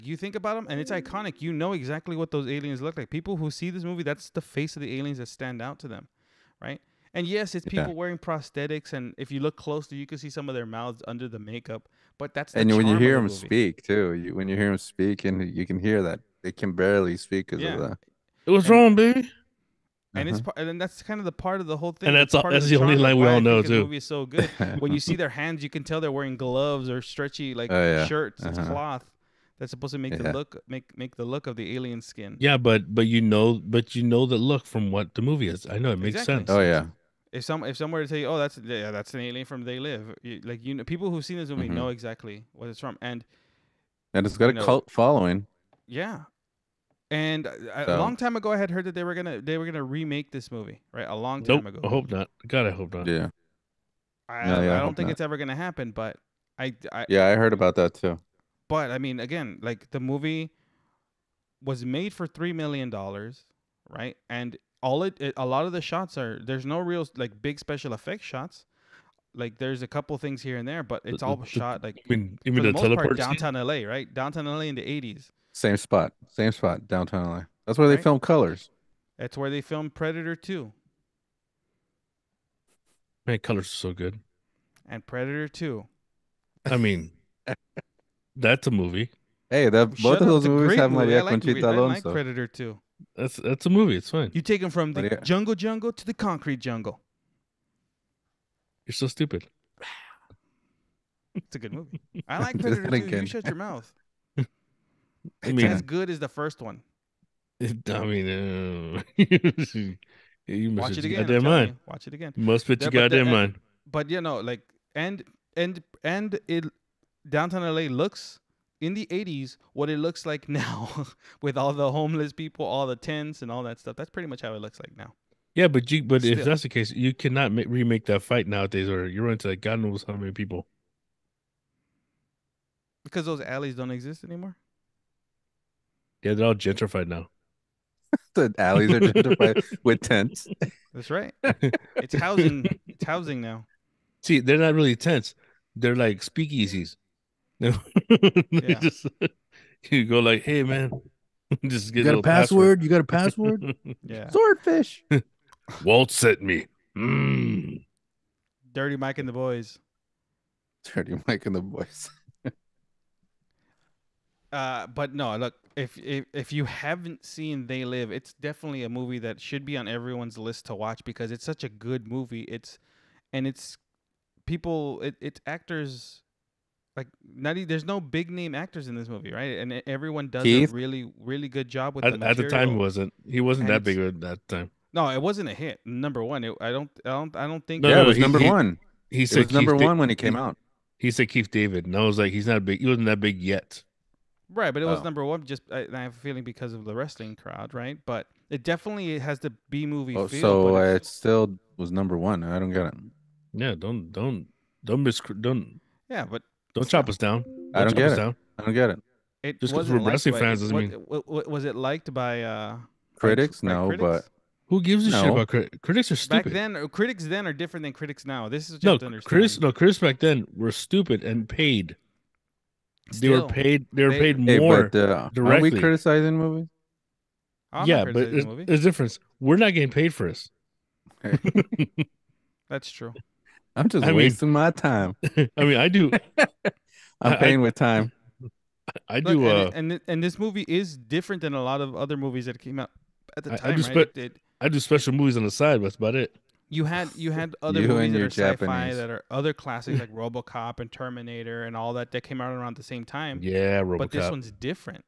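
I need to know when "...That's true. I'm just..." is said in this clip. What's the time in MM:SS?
03:52.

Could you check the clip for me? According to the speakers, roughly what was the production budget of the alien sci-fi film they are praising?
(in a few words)
3 million dollars.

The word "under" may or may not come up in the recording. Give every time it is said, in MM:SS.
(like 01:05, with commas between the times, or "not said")
00:11.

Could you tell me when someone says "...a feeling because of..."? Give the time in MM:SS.
03:16.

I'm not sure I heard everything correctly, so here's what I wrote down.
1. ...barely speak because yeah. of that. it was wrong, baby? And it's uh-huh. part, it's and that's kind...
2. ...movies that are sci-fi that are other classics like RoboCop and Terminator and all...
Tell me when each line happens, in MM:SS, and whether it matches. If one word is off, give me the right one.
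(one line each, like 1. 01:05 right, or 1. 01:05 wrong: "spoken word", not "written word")
1. 00:16 right
2. 04:07 right.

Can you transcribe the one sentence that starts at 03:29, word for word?
it Just because we're wrestling fans doesn't mean.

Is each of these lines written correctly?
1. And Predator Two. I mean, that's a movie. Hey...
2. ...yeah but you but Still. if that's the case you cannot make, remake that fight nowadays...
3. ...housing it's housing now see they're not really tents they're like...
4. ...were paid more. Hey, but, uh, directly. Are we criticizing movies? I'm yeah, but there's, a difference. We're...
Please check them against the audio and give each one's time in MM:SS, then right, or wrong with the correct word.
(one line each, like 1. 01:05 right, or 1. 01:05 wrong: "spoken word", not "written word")
1. 01:24 right
2. 02:05 right
3. 02:22 right
4. 03:44 right.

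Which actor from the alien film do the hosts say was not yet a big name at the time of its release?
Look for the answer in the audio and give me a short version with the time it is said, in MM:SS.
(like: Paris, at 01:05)
Keith David, at 03:11.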